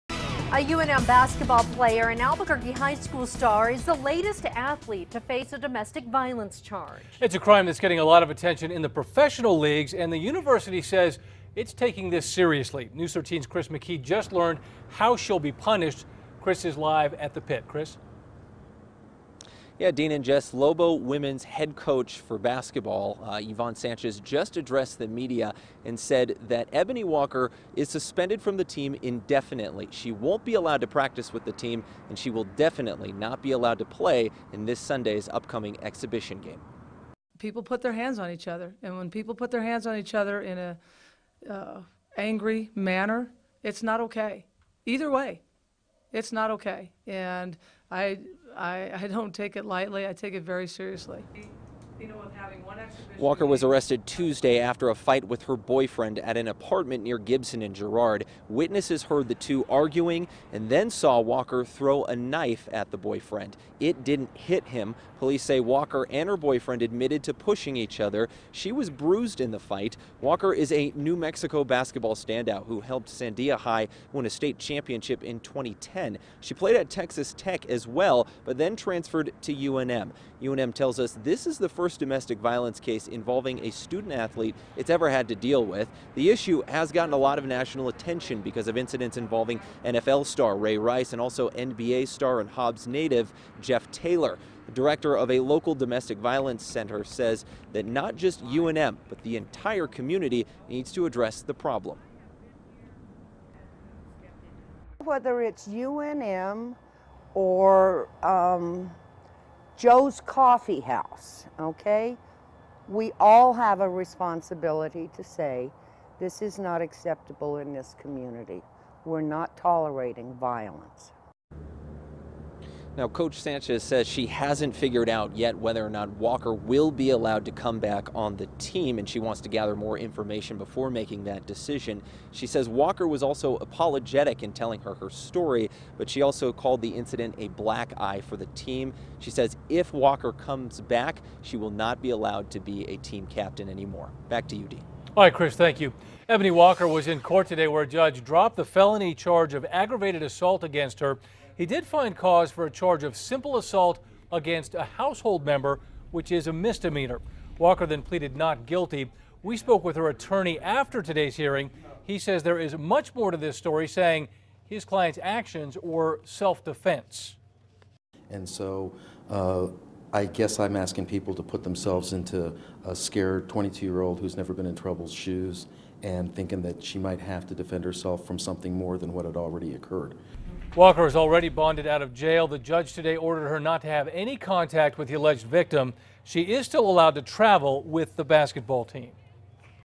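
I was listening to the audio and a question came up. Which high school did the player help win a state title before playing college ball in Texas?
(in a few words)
Sandia High.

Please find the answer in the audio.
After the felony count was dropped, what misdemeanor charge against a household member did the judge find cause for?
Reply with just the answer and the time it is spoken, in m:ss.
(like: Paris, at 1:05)
simple assault, at 2:33.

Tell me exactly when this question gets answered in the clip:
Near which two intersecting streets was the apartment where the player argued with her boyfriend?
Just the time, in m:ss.
0:57.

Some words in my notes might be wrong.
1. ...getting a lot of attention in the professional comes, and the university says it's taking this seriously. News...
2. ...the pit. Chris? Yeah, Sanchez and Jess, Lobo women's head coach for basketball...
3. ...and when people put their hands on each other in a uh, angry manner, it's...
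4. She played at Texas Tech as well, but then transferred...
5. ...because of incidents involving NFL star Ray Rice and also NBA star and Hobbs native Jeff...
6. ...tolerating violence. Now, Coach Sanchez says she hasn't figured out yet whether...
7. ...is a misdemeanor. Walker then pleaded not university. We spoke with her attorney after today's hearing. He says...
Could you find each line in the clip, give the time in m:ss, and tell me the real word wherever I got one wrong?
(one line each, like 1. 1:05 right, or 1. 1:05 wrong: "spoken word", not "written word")
1. 0:07 wrong: "leagues", not "comes"
2. 0:17 wrong: "Dean", not "Sanchez"
3. 0:38 right
4. 1:16 right
5. 1:28 right
6. 1:59 right
7. 2:36 wrong: "guilty", not "university".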